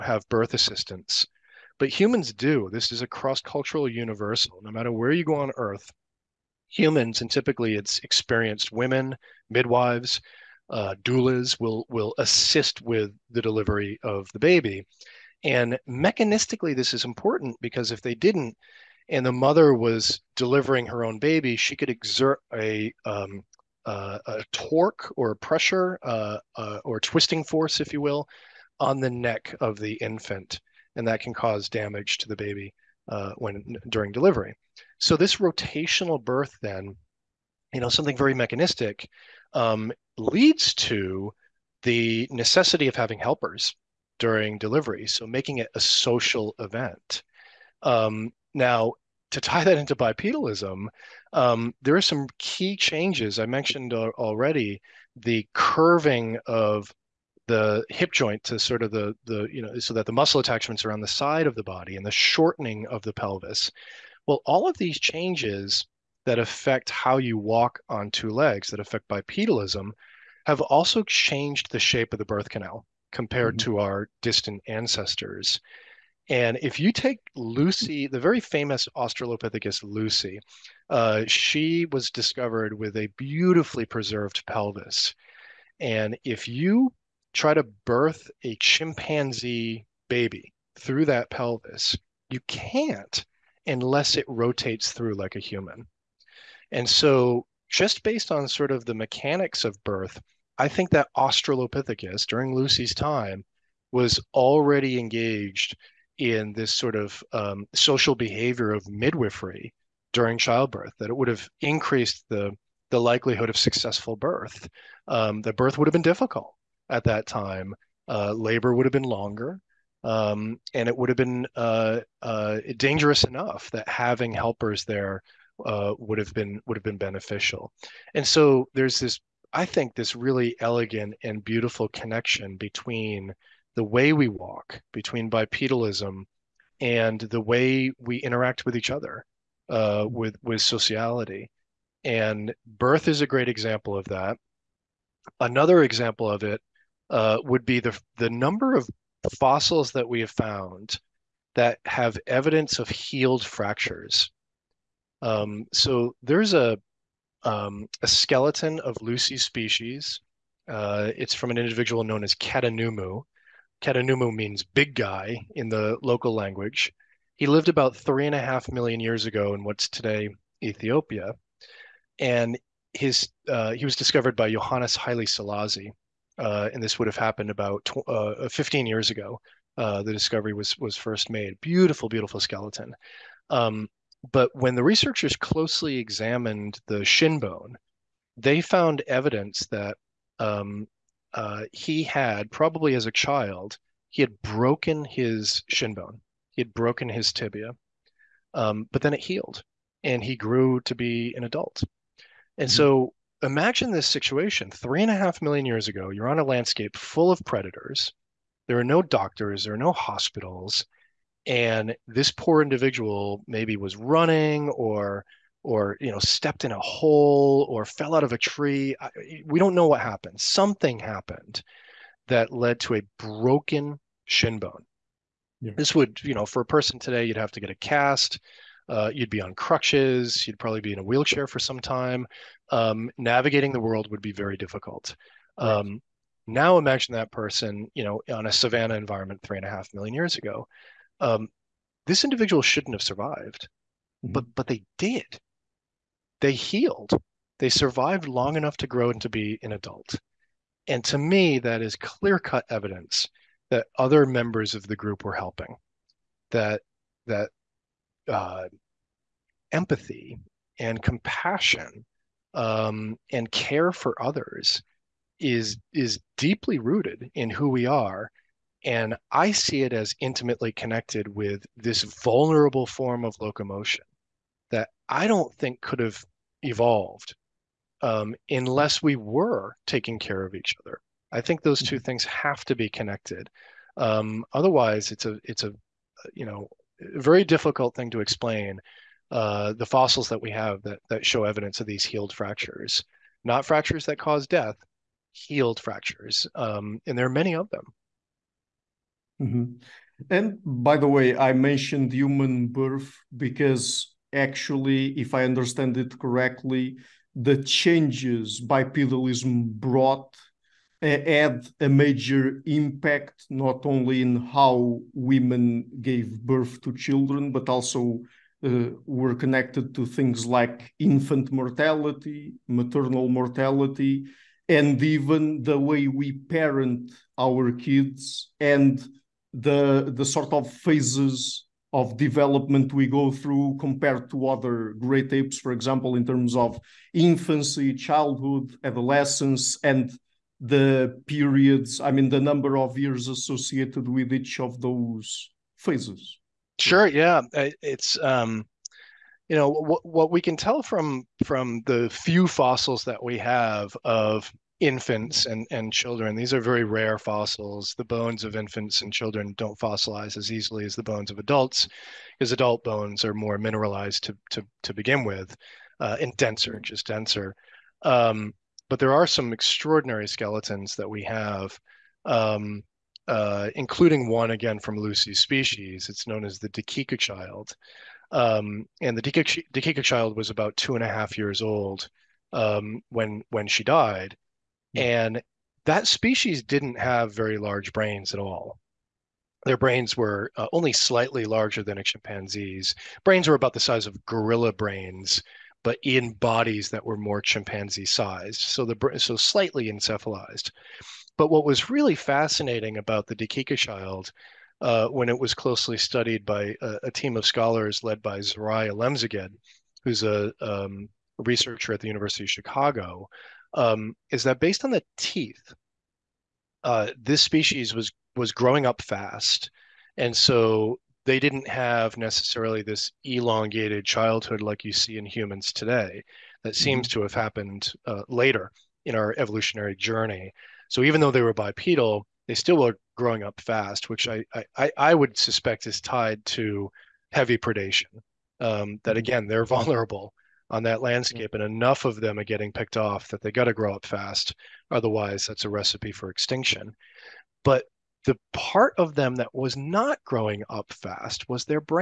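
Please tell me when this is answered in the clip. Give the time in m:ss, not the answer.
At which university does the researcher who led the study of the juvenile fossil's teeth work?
6:52.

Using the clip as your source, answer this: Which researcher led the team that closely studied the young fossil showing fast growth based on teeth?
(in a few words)
Zeresenay Alemseged.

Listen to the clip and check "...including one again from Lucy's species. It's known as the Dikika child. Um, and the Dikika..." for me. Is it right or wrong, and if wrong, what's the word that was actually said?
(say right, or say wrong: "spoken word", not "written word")
right.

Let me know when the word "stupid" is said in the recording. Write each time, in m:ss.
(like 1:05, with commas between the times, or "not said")
not said.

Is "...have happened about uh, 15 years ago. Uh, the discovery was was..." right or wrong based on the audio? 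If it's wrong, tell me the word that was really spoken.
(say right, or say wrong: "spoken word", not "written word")
right.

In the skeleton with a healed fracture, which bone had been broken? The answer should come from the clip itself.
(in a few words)
tibia.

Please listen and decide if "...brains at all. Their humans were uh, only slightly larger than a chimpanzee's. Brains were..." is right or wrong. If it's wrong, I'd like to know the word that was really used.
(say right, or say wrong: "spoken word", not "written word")
wrong: "brains", not "humans".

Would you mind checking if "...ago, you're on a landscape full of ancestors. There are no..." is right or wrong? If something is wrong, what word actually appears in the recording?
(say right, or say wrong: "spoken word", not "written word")
wrong: "predators", not "ancestors".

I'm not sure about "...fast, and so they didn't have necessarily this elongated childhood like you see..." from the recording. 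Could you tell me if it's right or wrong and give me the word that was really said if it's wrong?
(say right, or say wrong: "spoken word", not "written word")
right.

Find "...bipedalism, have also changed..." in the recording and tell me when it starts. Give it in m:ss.
1:09.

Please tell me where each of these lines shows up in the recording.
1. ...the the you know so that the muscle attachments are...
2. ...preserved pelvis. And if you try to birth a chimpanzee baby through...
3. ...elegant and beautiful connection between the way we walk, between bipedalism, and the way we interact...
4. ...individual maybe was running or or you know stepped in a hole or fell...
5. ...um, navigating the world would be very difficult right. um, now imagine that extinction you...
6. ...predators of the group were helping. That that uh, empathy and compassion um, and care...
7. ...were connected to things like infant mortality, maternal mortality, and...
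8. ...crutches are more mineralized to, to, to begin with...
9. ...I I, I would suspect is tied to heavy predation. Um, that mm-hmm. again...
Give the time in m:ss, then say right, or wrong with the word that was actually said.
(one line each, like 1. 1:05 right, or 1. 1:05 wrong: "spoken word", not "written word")
1. 0:58 right
2. 1:23 right
3. 2:10 right
4. 3:32 right
5. 3:52 wrong: "person", not "extinction"
6. 4:14 wrong: "members", not "predators"
7. 5:19 right
8. 6:02 wrong: "bones", not "crutches"
9. 7:14 right.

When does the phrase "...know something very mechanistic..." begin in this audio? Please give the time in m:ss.
0:37.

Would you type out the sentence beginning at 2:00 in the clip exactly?
Um, and it would have been uh, uh, dangerous enough that having helpers there uh, would have been would have been beneficial.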